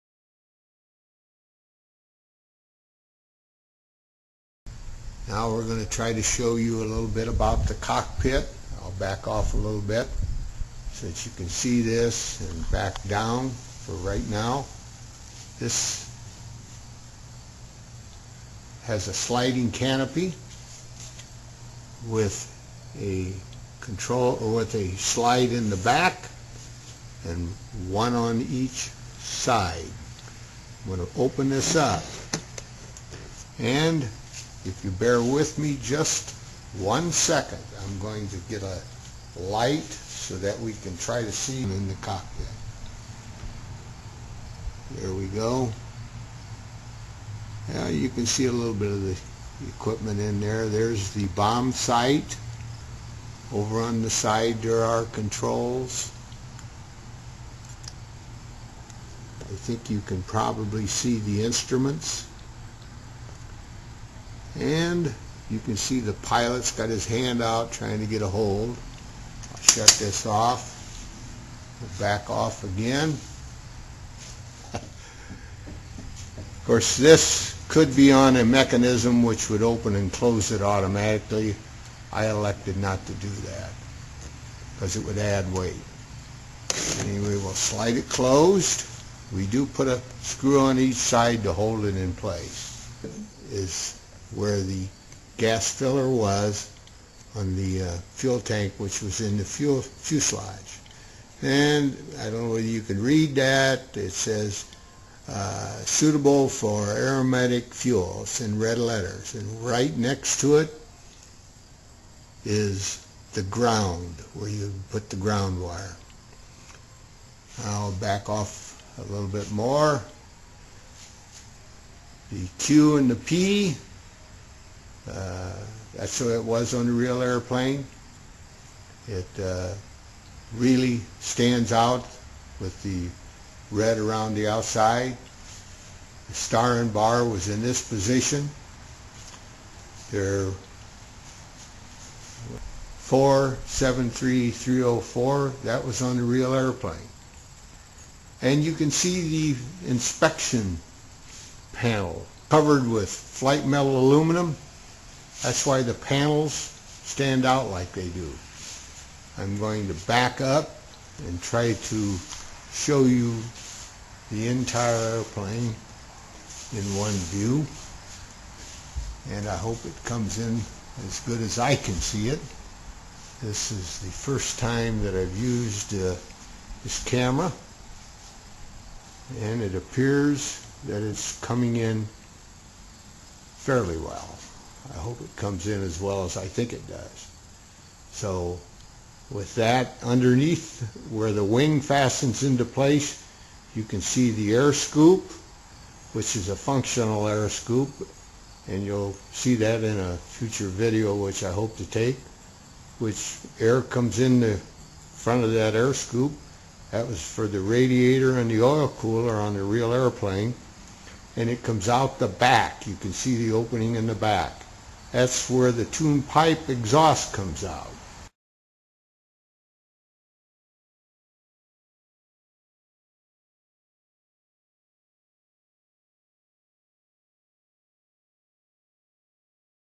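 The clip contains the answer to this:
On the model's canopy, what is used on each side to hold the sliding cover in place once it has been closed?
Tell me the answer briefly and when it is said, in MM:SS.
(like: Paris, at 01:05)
A screw, at 01:29.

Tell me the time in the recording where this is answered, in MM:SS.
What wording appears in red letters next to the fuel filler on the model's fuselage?
01:45.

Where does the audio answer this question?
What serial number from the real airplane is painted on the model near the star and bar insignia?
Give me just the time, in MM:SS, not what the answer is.
02:22.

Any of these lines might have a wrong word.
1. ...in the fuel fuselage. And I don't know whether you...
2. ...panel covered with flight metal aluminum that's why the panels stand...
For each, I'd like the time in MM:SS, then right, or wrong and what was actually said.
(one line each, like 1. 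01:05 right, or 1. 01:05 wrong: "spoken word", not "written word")
1. 01:39 right
2. 02:31 right.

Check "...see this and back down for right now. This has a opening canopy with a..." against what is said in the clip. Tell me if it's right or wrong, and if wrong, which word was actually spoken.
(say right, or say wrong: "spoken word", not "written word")
wrong: "sliding", not "opening".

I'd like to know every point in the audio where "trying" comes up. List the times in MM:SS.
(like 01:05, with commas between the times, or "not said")
01:07.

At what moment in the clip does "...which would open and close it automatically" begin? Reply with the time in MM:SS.
01:19.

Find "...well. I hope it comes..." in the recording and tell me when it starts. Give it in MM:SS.
03:03.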